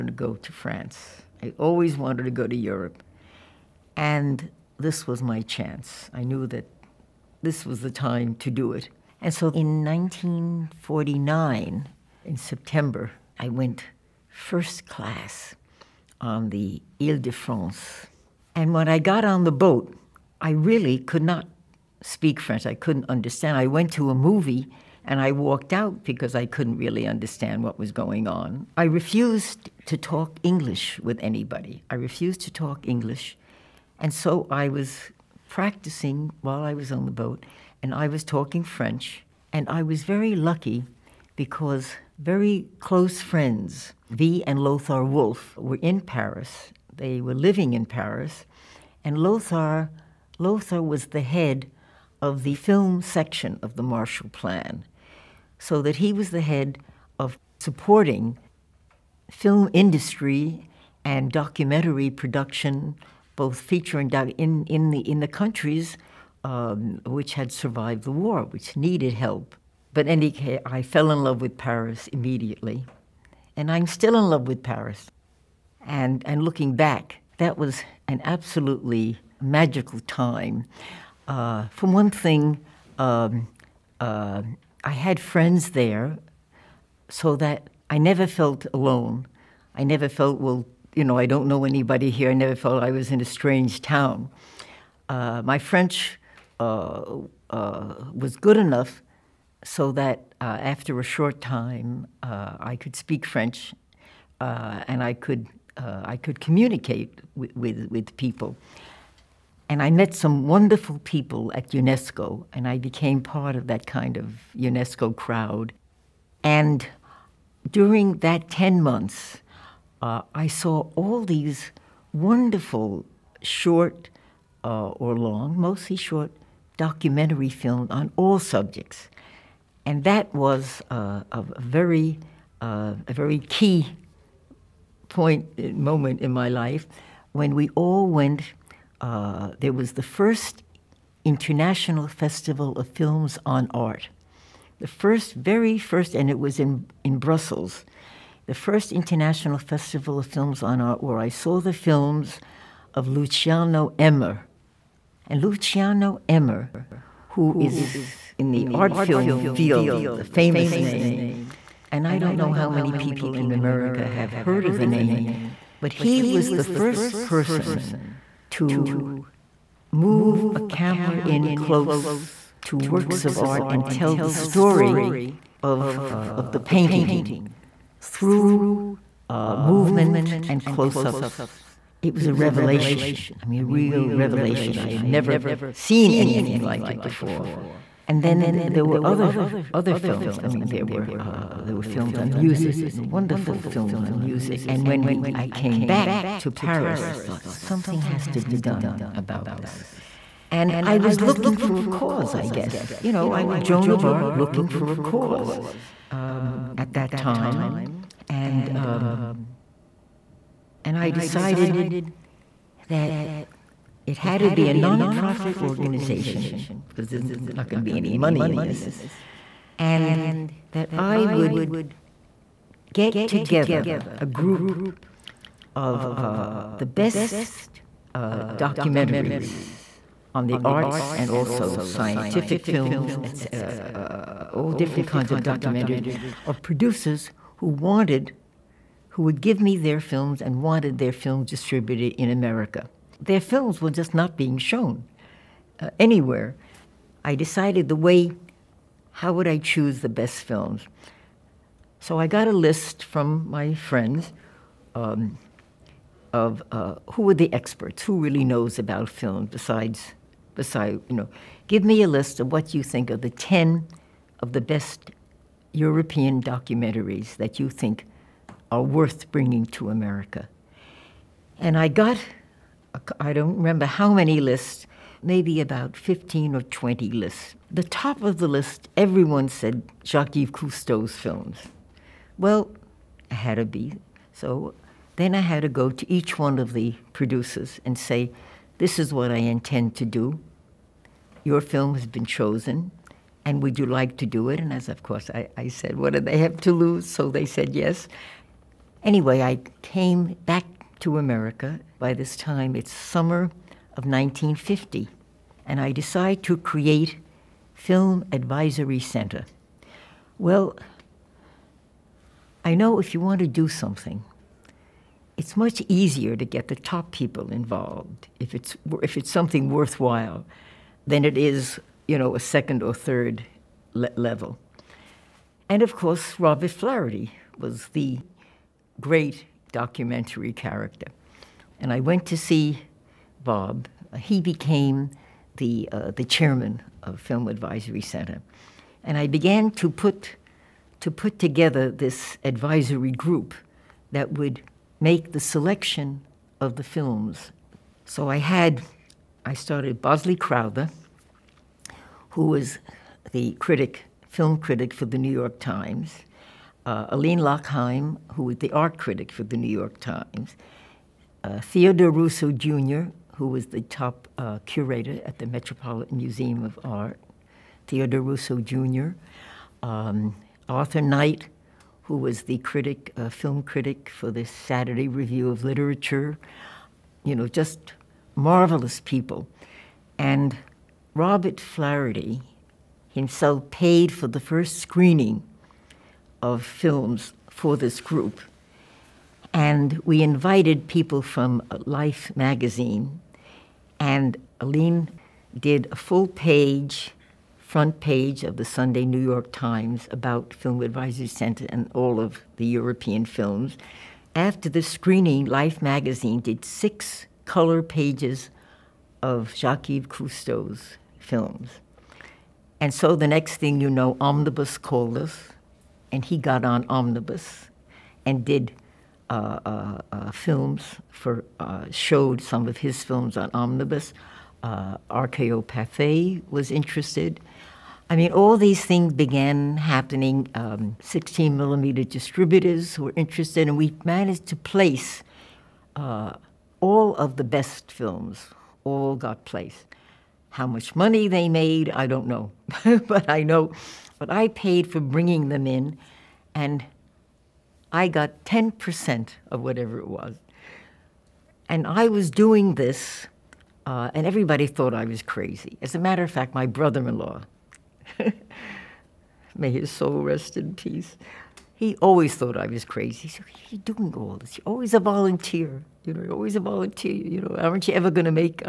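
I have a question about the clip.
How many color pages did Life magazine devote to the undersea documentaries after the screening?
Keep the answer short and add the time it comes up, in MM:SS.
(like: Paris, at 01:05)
6, at 06:46.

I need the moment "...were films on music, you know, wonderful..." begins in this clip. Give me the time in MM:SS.
03:11.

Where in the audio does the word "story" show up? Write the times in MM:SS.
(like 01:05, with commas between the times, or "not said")
02:54.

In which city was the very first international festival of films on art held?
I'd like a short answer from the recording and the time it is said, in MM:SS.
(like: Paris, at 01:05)
Brussels, at 02:27.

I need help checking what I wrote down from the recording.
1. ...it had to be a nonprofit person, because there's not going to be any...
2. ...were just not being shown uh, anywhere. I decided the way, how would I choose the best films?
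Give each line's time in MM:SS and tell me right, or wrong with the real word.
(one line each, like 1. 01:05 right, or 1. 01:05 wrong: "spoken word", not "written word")
1. 03:34 wrong: "organization", not "person"
2. 04:03 right.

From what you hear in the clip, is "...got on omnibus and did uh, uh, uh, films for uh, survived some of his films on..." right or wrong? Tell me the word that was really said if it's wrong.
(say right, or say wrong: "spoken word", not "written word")
wrong: "showed", not "survived".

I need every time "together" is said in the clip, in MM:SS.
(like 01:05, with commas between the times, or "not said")
03:43, 05:41.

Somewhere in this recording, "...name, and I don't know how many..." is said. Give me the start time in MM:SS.
02:40.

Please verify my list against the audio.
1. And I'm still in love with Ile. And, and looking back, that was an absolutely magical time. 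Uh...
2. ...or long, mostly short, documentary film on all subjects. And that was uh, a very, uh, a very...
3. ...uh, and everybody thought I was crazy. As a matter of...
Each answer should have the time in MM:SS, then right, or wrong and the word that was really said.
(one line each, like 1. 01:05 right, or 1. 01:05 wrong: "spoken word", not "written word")
1. 01:13 wrong: "Paris", not "Ile"
2. 02:04 right
3. 07:33 right.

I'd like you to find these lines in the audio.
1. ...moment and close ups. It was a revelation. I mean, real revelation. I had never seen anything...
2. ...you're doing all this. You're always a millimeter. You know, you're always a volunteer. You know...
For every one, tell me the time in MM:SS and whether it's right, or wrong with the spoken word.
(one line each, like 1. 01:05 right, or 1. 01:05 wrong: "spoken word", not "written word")
1. 02:59 wrong: "movement", not "moment"
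2. 07:43 wrong: "volunteer", not "millimeter".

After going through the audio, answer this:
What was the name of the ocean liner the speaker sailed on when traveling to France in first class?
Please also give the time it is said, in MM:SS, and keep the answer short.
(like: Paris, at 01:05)
Ile de France, at 00:17.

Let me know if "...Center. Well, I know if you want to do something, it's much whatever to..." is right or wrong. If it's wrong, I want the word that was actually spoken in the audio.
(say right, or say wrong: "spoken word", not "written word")
wrong: "easier", not "whatever".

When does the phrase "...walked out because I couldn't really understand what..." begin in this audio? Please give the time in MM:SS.
00:25.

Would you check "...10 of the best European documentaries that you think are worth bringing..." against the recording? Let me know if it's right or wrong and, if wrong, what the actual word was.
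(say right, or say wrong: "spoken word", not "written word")
right.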